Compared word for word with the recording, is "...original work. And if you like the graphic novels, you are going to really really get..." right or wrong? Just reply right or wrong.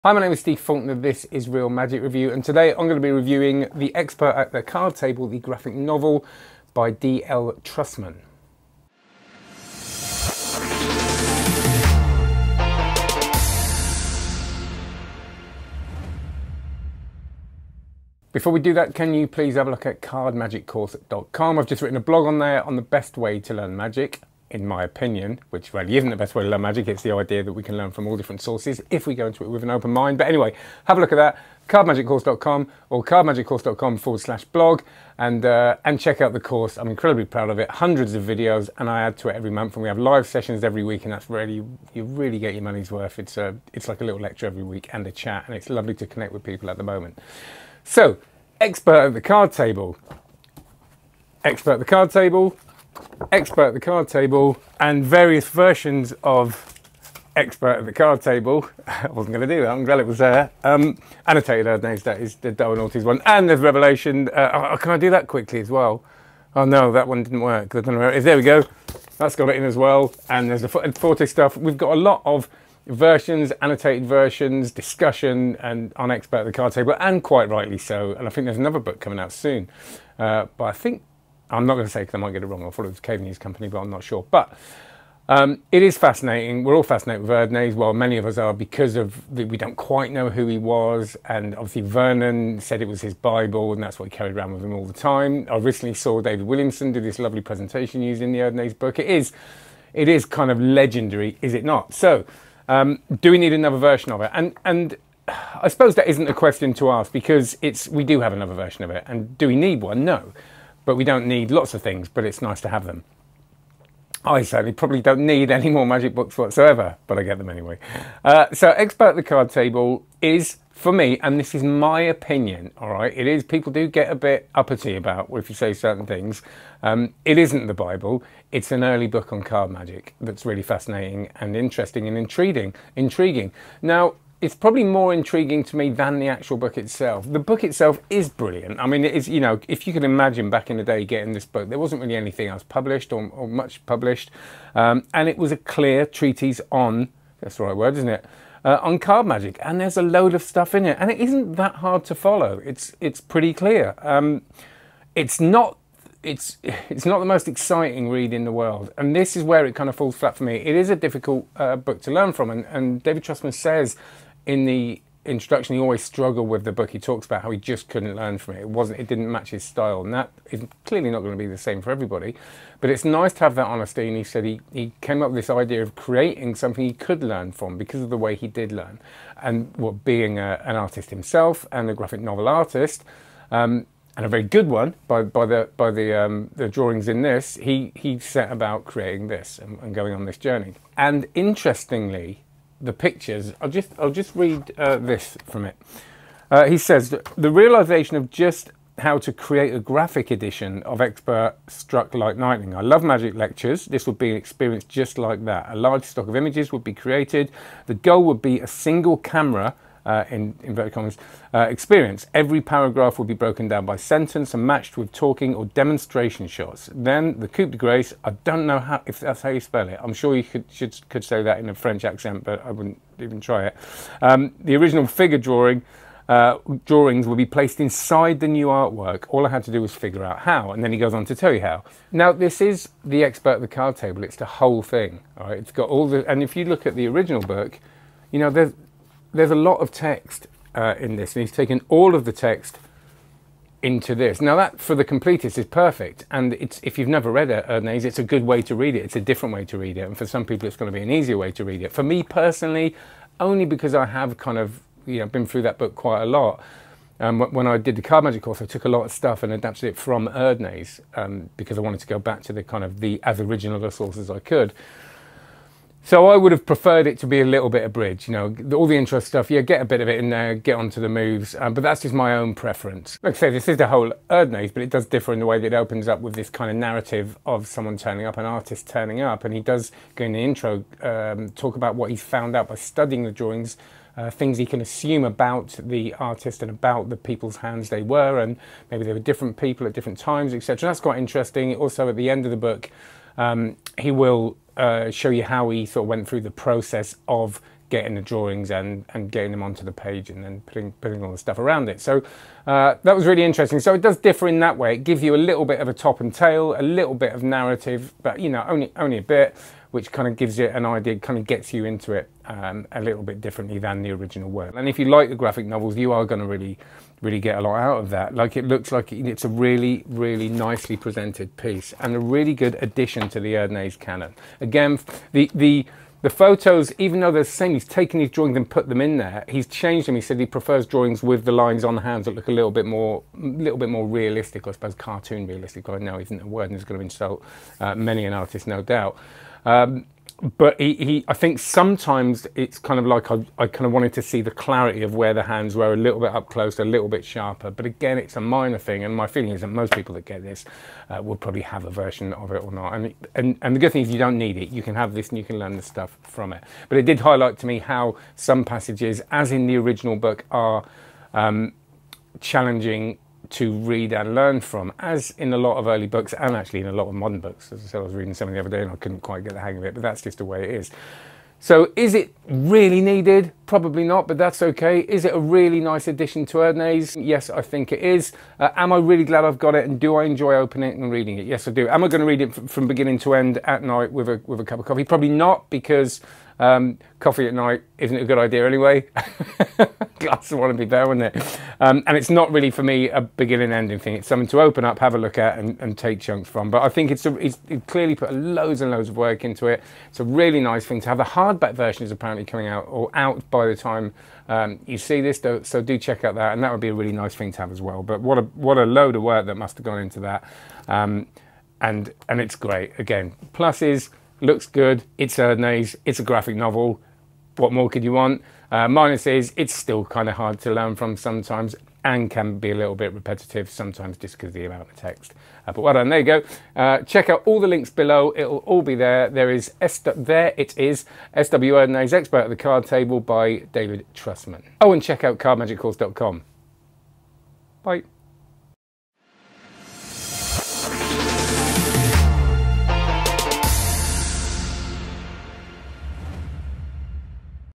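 right.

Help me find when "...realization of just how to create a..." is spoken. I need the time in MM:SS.
03:17.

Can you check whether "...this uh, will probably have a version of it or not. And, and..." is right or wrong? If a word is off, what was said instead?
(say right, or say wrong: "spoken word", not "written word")
right.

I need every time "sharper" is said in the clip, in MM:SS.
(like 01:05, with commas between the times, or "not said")
05:47.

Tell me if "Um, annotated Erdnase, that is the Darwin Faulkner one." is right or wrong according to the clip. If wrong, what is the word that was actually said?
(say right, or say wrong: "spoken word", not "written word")
wrong: "Ortiz", not "Faulkner".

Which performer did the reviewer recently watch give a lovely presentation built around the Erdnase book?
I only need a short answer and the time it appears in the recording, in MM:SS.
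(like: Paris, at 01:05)
David Williamson, at 01:36.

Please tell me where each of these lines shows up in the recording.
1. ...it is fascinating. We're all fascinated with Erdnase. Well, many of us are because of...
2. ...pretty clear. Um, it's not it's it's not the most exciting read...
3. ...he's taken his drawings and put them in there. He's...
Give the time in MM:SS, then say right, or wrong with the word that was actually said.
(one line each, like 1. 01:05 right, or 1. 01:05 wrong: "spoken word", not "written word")
1. 01:25 right
2. 02:33 right
3. 05:27 right.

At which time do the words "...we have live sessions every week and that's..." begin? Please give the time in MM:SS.
00:39.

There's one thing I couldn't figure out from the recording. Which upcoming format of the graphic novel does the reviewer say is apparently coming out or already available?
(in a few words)
hardback version.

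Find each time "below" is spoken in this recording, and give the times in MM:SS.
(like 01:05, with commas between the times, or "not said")
07:07.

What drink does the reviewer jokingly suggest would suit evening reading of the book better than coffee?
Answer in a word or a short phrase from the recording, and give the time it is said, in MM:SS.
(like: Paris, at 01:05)
Glass of wine, at 06:30.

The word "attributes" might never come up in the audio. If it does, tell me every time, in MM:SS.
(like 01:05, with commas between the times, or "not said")
not said.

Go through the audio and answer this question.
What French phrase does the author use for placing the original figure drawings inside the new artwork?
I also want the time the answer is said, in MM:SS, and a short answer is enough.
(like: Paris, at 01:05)
coup de grace, at 03:37.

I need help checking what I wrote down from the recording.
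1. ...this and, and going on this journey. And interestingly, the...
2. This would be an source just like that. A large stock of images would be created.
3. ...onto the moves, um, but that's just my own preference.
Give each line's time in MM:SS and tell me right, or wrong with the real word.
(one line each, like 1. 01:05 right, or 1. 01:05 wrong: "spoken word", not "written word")
1. 03:09 right
2. 03:23 wrong: "experience", not "source"
3. 04:30 right.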